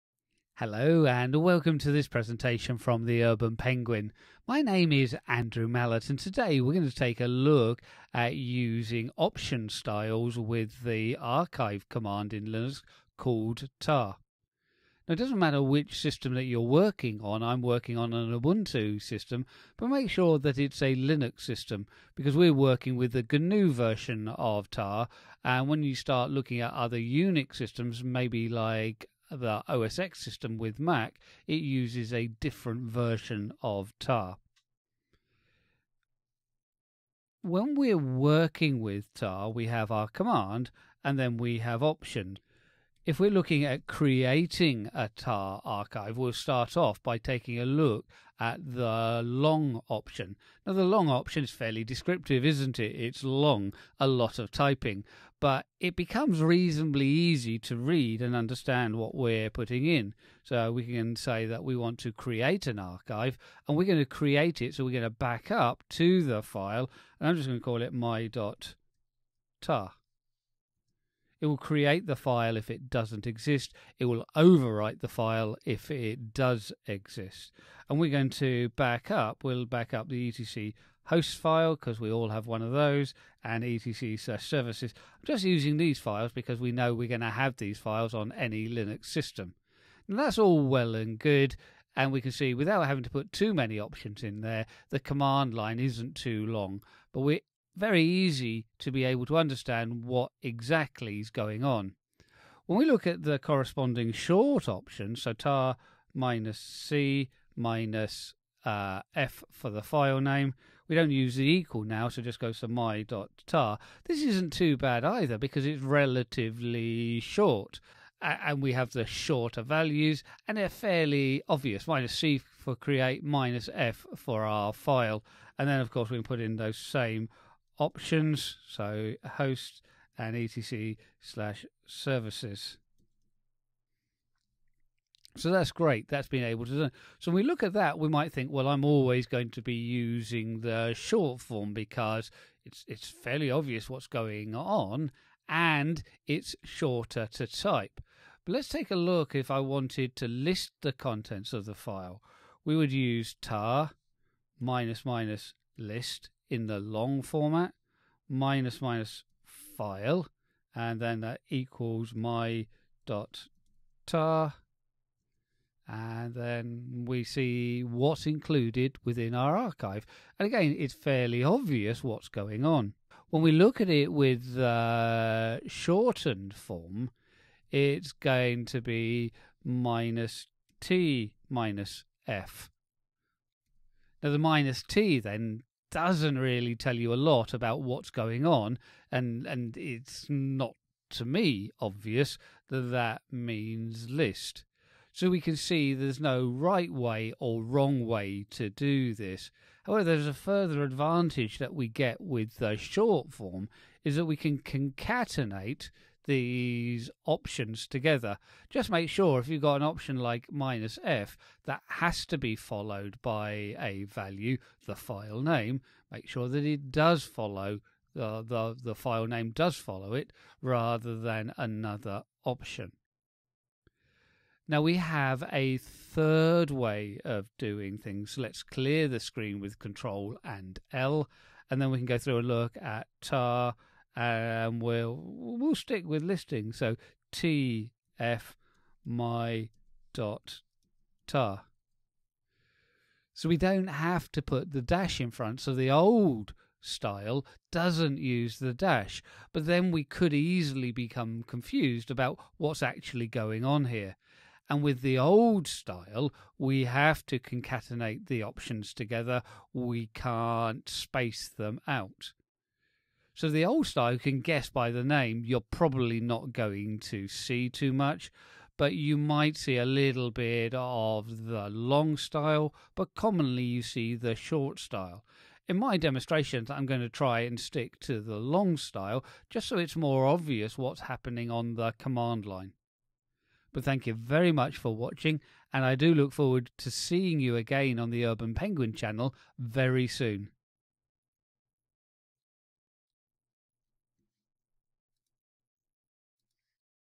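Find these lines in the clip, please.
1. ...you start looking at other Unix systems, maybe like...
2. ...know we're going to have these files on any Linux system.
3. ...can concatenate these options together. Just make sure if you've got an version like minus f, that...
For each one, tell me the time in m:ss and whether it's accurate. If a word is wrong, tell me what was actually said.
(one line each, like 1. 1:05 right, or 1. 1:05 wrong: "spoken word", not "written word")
1. 0:25 right
2. 1:26 right
3. 3:24 wrong: "option", not "version".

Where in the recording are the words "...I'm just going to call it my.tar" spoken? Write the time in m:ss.
1:07.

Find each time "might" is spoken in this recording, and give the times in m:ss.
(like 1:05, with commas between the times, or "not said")
2:18, 4:29.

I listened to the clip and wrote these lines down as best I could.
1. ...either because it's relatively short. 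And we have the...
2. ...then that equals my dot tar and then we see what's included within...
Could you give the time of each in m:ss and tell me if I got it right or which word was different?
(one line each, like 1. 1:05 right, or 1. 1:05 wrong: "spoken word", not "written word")
1. 1:55 right
2. 2:40 right.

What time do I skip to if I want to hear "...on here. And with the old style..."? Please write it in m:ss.
4:13.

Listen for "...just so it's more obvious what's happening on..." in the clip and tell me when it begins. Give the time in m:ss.
4:39.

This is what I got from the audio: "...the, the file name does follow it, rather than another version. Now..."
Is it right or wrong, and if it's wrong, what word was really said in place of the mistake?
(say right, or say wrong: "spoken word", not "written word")
wrong: "option", not "version".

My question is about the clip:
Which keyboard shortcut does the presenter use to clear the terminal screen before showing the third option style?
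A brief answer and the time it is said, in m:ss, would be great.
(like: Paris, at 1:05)
Control and L, at 3:49.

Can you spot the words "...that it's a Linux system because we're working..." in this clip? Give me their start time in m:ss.
0:20.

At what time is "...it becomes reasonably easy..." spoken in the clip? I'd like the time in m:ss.
0:55.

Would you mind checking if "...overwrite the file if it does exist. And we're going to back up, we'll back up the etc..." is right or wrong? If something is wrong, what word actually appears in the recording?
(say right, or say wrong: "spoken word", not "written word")
right.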